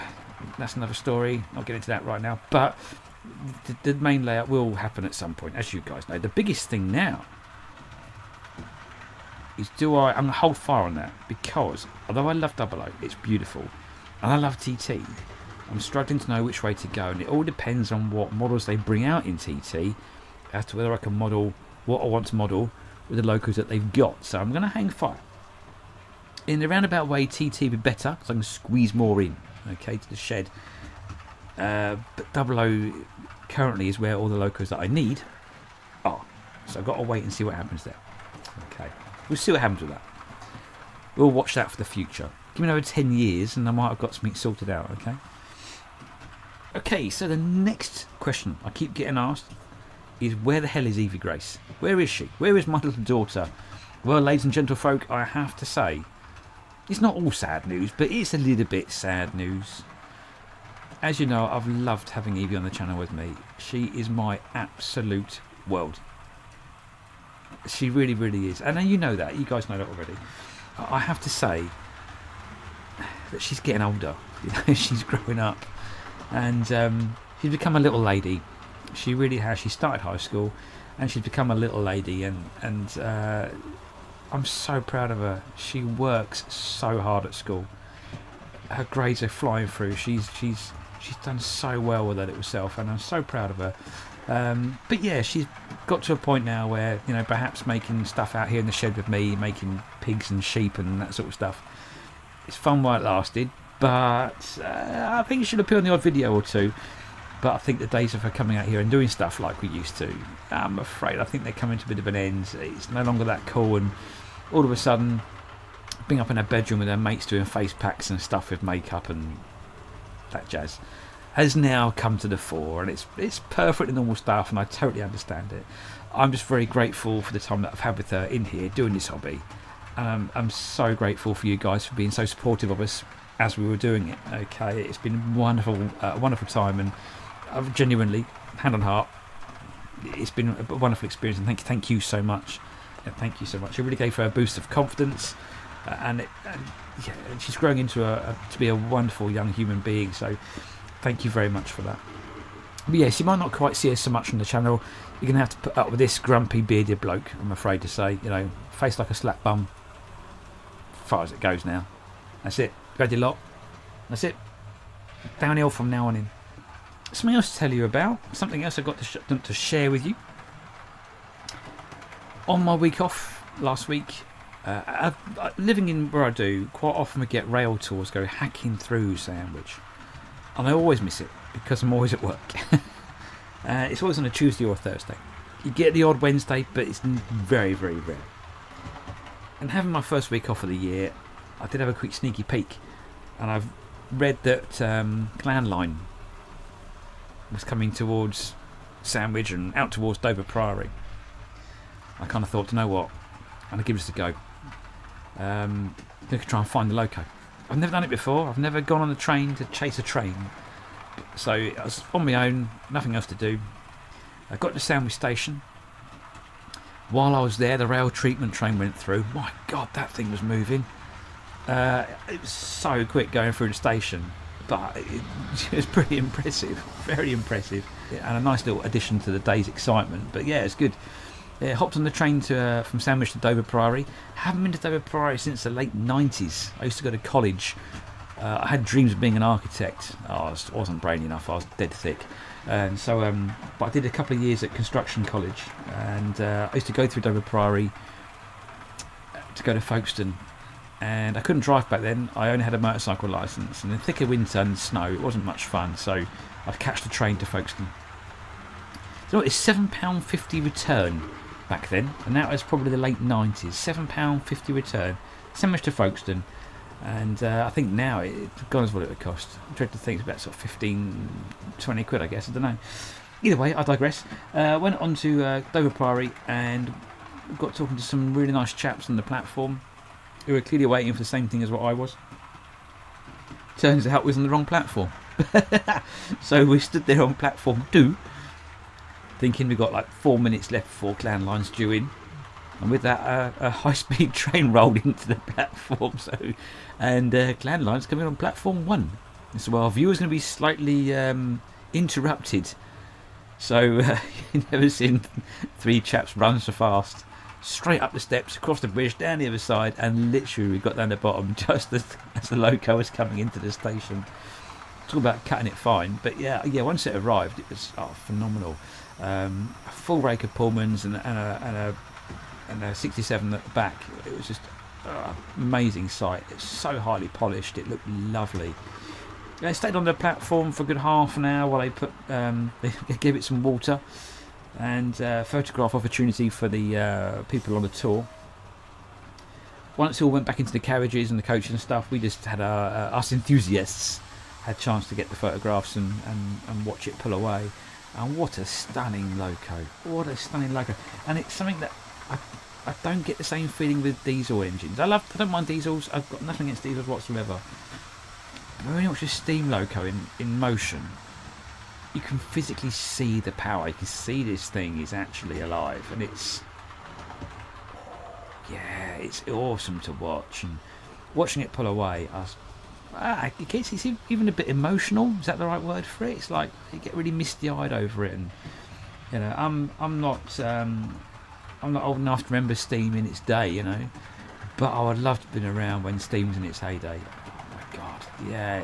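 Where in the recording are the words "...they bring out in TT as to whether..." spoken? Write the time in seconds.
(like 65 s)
18 s.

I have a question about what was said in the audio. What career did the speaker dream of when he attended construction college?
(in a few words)
Architect.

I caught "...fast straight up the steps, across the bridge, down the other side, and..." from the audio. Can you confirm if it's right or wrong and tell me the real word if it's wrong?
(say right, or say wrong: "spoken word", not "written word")
right.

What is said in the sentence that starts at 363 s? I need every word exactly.
You can see this thing is actually alive, and it's yeah, it's awesome to watch.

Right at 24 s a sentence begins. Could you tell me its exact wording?
So I'm going to hang fire.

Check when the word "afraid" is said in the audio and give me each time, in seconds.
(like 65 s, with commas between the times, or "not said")
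110 s, 157 s.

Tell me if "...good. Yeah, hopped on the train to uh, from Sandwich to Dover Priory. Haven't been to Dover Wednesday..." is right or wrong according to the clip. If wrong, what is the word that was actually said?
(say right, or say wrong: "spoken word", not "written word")
wrong: "Priory", not "Wednesday".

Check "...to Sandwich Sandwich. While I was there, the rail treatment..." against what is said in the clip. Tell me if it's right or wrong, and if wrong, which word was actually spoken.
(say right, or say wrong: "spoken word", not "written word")
wrong: "Station", not "Sandwich".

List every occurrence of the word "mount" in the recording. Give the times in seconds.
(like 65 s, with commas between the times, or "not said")
not said.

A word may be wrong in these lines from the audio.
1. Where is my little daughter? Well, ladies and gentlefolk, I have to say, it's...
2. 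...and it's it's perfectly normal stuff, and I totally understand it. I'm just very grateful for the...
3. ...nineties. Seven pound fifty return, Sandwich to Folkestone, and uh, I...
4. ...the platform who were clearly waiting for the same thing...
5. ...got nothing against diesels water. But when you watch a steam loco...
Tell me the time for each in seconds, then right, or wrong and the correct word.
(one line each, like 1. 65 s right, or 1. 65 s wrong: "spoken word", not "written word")
1. 52 s right
2. 122 s right
3. 263 s right
4. 279 s right
5. 356 s wrong: "whatsoever", not "water".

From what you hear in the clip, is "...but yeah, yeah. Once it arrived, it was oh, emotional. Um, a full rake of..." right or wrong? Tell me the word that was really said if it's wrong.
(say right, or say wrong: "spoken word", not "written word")
wrong: "phenomenal", not "emotional".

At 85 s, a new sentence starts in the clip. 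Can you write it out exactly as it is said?
She works so hard at school.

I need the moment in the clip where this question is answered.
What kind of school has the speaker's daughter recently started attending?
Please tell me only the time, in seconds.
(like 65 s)
80 s.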